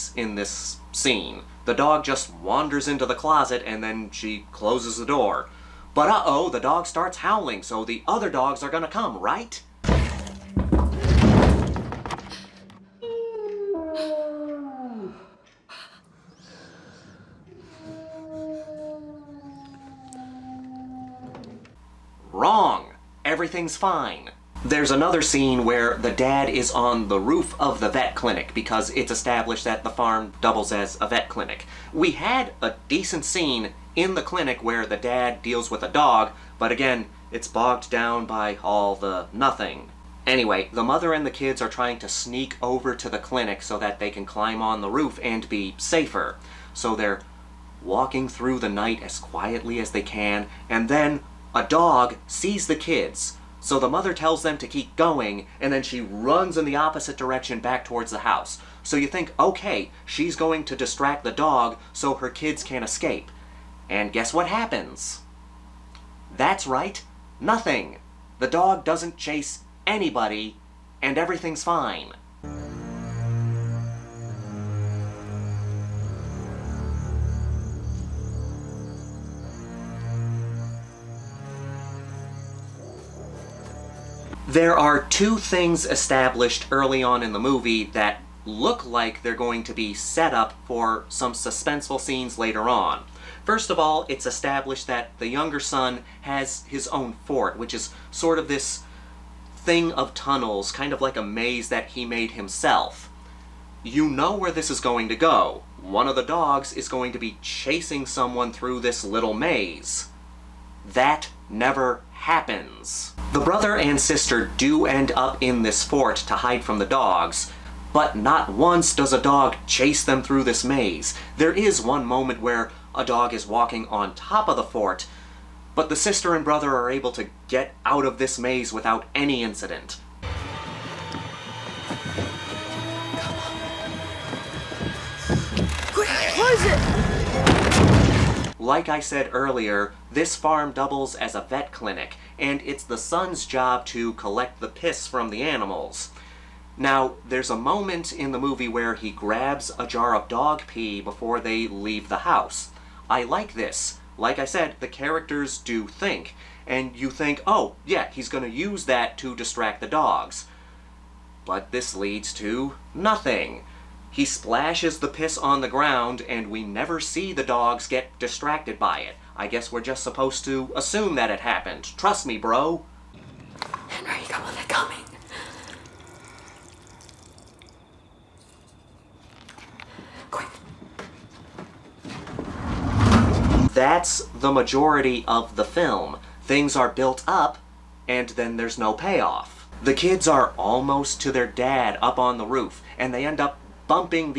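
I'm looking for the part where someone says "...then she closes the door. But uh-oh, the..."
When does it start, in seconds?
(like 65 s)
3 s.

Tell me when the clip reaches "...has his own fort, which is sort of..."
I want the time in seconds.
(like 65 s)
96 s.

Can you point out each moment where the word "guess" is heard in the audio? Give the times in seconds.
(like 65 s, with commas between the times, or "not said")
64 s, 169 s.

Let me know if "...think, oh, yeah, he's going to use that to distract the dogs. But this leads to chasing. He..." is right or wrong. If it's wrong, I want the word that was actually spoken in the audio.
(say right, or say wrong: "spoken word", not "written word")
wrong: "nothing", not "chasing".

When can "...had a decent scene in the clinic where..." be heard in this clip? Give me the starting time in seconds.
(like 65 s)
32 s.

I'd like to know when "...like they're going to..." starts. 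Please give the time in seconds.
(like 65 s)
88 s.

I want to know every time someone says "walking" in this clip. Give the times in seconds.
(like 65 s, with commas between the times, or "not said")
47 s, 123 s.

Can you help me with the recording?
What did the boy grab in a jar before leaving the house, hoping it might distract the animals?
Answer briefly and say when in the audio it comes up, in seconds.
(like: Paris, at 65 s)
Dog pee, at 150 s.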